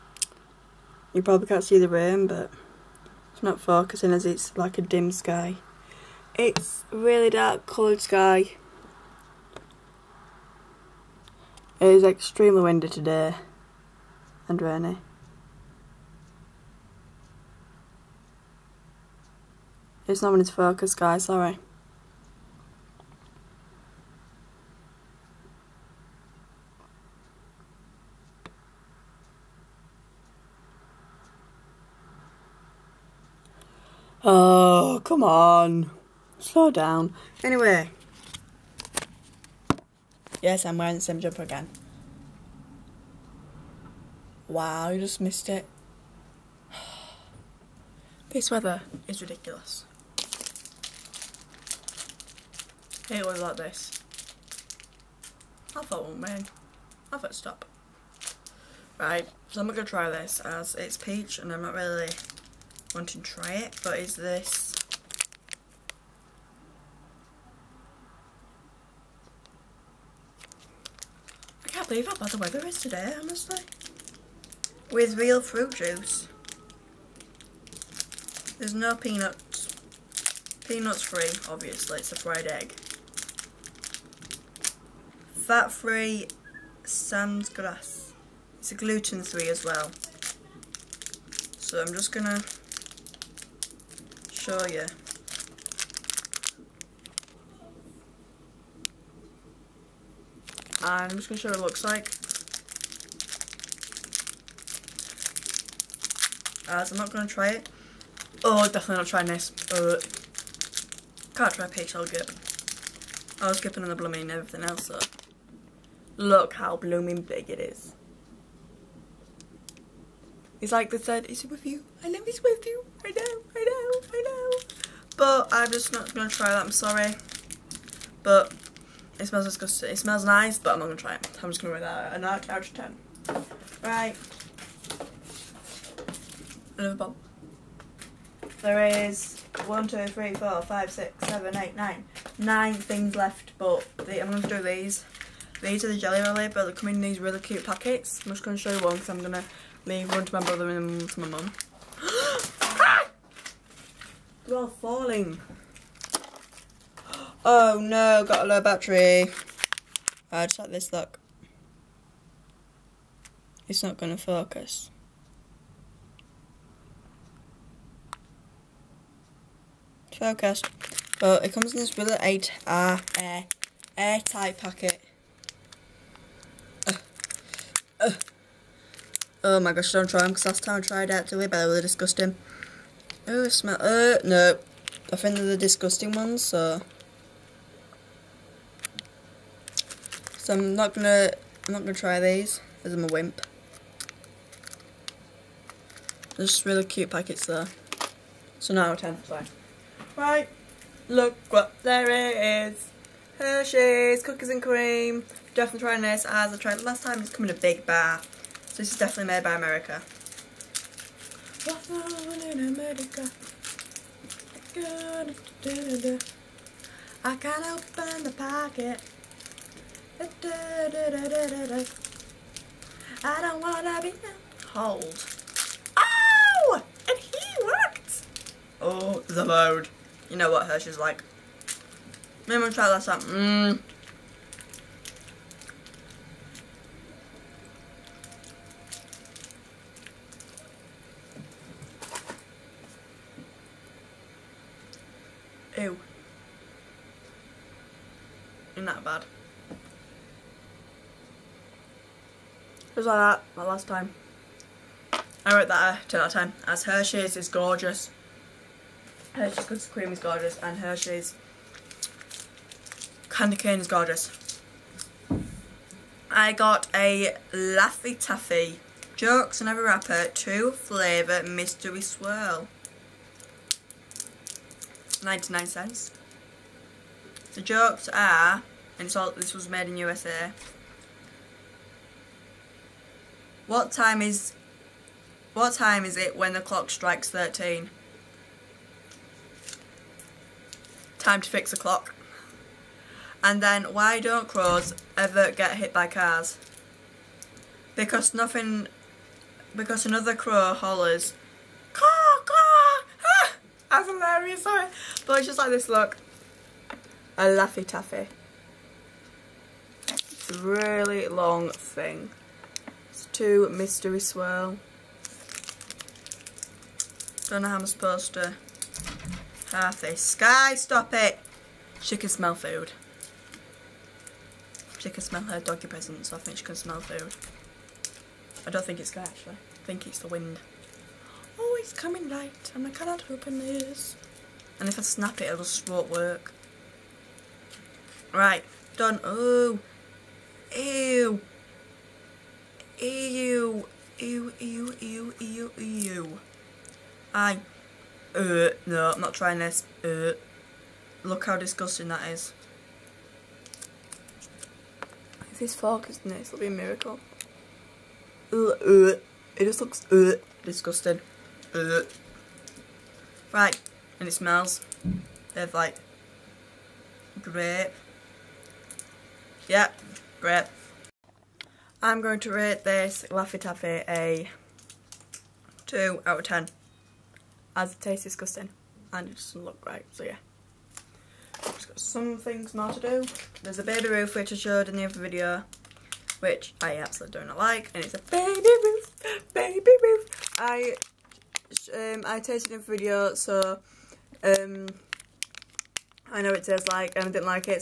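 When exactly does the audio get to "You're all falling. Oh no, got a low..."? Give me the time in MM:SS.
02:34.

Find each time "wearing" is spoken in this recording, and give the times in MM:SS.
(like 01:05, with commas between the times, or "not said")
00:40.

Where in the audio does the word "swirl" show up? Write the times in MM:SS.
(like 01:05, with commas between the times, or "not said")
04:32, 05:14.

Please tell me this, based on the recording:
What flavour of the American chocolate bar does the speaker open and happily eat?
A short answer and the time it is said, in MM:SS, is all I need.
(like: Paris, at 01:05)
cookies and cream, at 03:24.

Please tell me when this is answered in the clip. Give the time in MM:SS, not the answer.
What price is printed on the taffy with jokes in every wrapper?
04:35.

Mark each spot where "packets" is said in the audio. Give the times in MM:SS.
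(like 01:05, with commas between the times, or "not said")
02:27, 02:54, 03:17, 03:38.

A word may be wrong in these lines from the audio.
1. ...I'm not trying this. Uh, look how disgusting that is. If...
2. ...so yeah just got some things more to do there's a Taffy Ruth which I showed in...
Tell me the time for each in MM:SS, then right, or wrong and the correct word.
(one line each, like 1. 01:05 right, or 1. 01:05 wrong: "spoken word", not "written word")
1. 05:49 right
2. 06:20 wrong: "Baby", not "Taffy".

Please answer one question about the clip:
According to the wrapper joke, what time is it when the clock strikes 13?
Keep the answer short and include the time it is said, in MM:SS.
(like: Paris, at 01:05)
Time to fix the clock, at 04:51.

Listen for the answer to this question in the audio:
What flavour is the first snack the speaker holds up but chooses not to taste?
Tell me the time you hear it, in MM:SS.
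01:00.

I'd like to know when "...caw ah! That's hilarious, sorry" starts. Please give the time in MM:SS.
05:02.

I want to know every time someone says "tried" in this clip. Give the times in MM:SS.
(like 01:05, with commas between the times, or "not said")
03:00, 03:26.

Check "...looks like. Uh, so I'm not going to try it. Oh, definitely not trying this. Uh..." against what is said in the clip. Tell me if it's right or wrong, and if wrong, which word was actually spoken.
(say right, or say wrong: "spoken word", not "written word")
right.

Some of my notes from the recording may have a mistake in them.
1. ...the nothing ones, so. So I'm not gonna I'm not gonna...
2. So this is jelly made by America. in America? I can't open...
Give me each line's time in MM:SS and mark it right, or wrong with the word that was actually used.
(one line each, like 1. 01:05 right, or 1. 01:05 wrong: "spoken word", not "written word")
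1. 03:05 wrong: "disgusting", not "nothing"
2. 03:28 wrong: "definitely", not "jelly".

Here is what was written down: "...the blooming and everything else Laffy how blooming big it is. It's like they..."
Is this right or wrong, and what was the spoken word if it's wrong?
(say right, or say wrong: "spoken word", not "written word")
wrong: "Look", not "Laffy".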